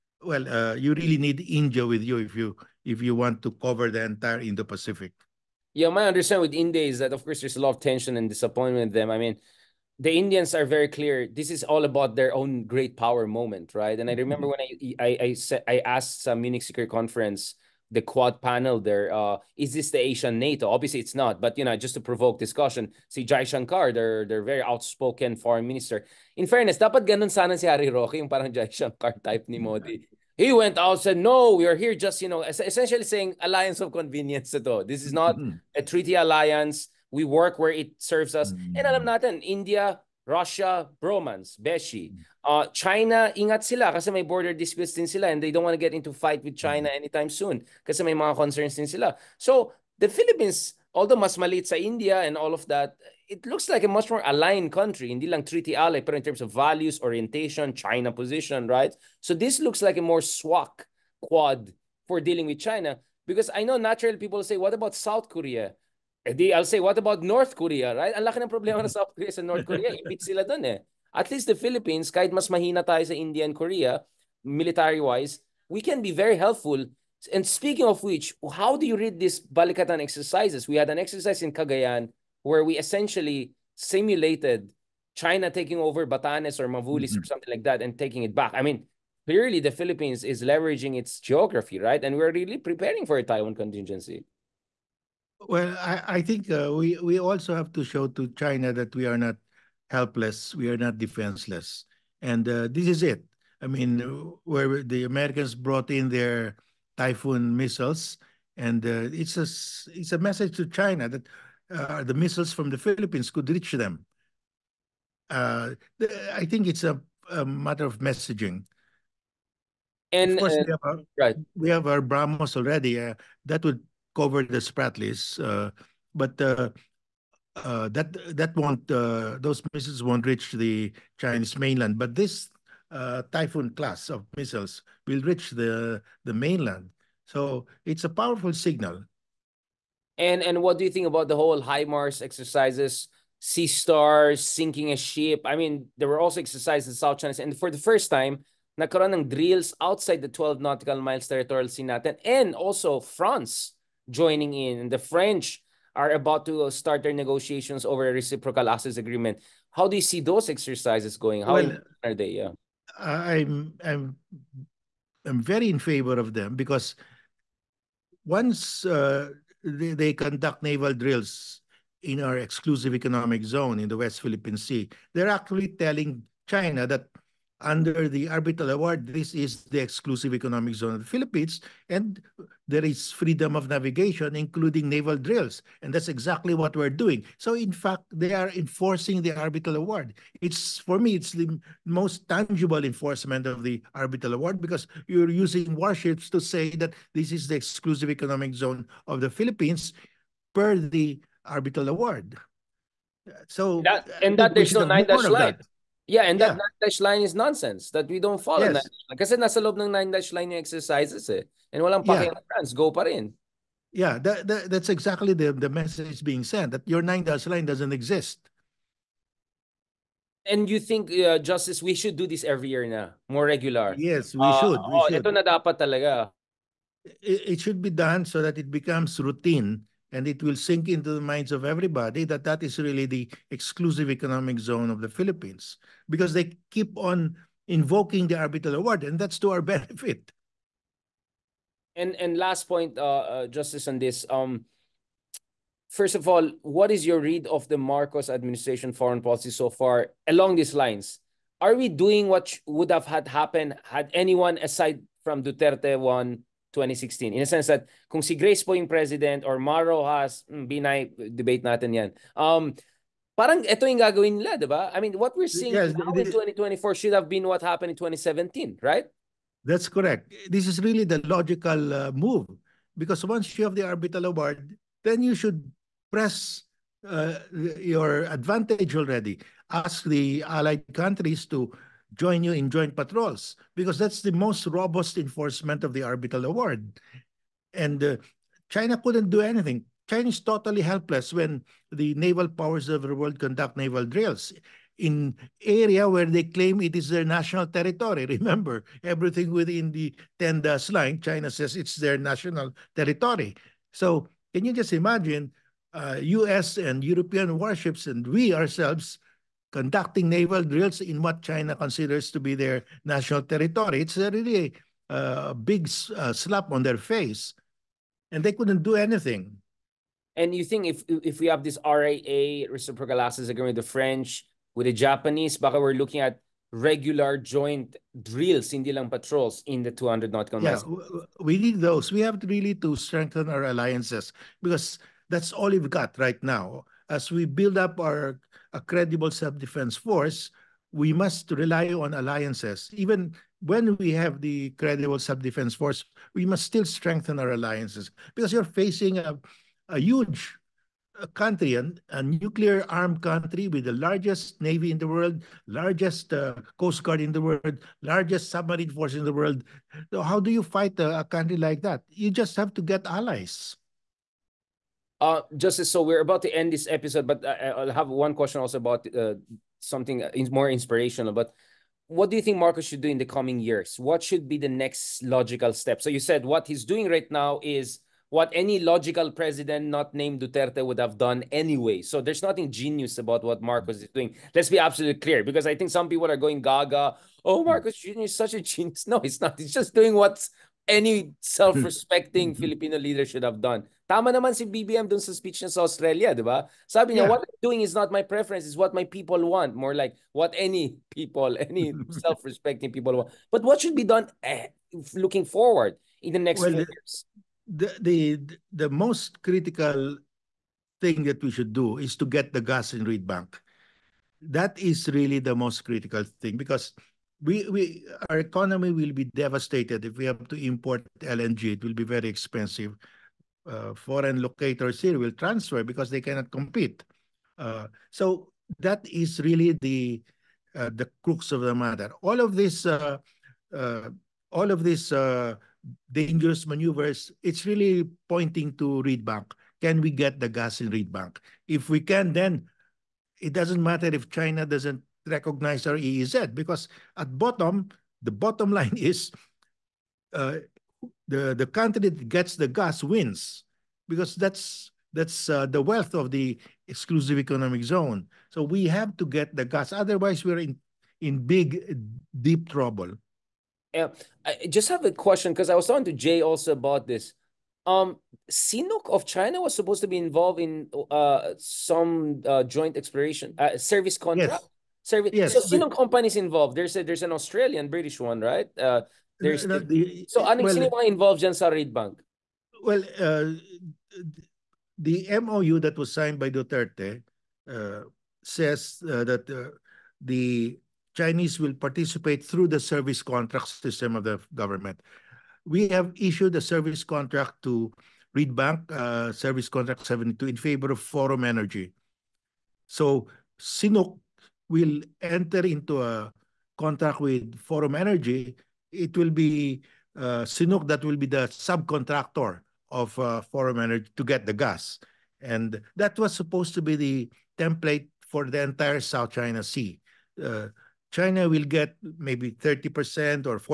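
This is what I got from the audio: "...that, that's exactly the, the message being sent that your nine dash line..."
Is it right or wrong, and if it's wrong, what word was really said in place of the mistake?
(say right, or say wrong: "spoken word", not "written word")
right.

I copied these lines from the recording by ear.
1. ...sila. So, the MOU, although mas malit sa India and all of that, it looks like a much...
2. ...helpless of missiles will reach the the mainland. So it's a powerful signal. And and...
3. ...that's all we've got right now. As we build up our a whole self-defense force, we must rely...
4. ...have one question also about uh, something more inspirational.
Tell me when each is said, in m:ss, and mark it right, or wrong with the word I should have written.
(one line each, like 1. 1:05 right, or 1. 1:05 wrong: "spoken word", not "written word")
1. 0:48 wrong: "Philippines", not "MOU"
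2. 2:13 wrong: "class", not "helpless"
3. 5:35 wrong: "credible", not "whole"
4. 6:07 right.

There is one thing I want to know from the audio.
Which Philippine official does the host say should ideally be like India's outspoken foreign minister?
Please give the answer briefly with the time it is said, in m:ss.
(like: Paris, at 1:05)
Harry Roque, at 0:27.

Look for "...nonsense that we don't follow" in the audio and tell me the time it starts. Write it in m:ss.
3:27.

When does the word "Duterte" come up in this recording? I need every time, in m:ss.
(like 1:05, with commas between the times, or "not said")
4:15, 6:20, 8:06.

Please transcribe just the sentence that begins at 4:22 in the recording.
Um, parang ito yung gagawin nila, di ba?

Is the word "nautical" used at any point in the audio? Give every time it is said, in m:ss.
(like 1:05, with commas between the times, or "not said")
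2:30, 5:30.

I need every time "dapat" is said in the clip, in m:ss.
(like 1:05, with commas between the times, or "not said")
0:26, 3:45.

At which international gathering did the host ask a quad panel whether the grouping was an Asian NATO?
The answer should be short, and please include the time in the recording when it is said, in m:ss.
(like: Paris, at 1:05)
Munich Security Conference, at 0:16.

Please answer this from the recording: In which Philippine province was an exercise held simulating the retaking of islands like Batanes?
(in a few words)
Cagayan.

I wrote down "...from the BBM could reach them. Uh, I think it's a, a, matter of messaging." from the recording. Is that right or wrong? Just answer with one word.
wrong.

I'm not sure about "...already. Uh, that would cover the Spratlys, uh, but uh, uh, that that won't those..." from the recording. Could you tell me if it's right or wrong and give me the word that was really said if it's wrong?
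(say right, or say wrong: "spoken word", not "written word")
right.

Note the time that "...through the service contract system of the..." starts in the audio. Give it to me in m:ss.
8:12.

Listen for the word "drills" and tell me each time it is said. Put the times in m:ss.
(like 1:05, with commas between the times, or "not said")
2:29, 2:50, 3:05, 4:54, 5:10, 5:28.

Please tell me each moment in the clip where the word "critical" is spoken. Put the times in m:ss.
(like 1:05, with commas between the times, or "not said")
6:49, 6:55.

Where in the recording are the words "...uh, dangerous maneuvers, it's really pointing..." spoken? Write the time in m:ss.
7:15.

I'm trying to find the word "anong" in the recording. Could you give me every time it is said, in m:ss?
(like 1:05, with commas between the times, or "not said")
8:00.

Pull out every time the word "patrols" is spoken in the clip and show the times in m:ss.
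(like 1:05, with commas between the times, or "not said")
4:42, 5:29.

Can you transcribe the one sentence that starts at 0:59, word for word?
So this looks like a more SWAC quad for dealing with China because I know naturally people say, what about South Korea?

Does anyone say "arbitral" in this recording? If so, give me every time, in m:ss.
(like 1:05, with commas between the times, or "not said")
2:58, 3:09, 3:13, 3:21, 3:58, 4:33, 4:46.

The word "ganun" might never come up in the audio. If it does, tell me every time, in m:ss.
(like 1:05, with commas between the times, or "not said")
0:27.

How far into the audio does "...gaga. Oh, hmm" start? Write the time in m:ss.
6:26.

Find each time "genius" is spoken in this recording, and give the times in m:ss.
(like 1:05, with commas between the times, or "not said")
6:22, 6:28.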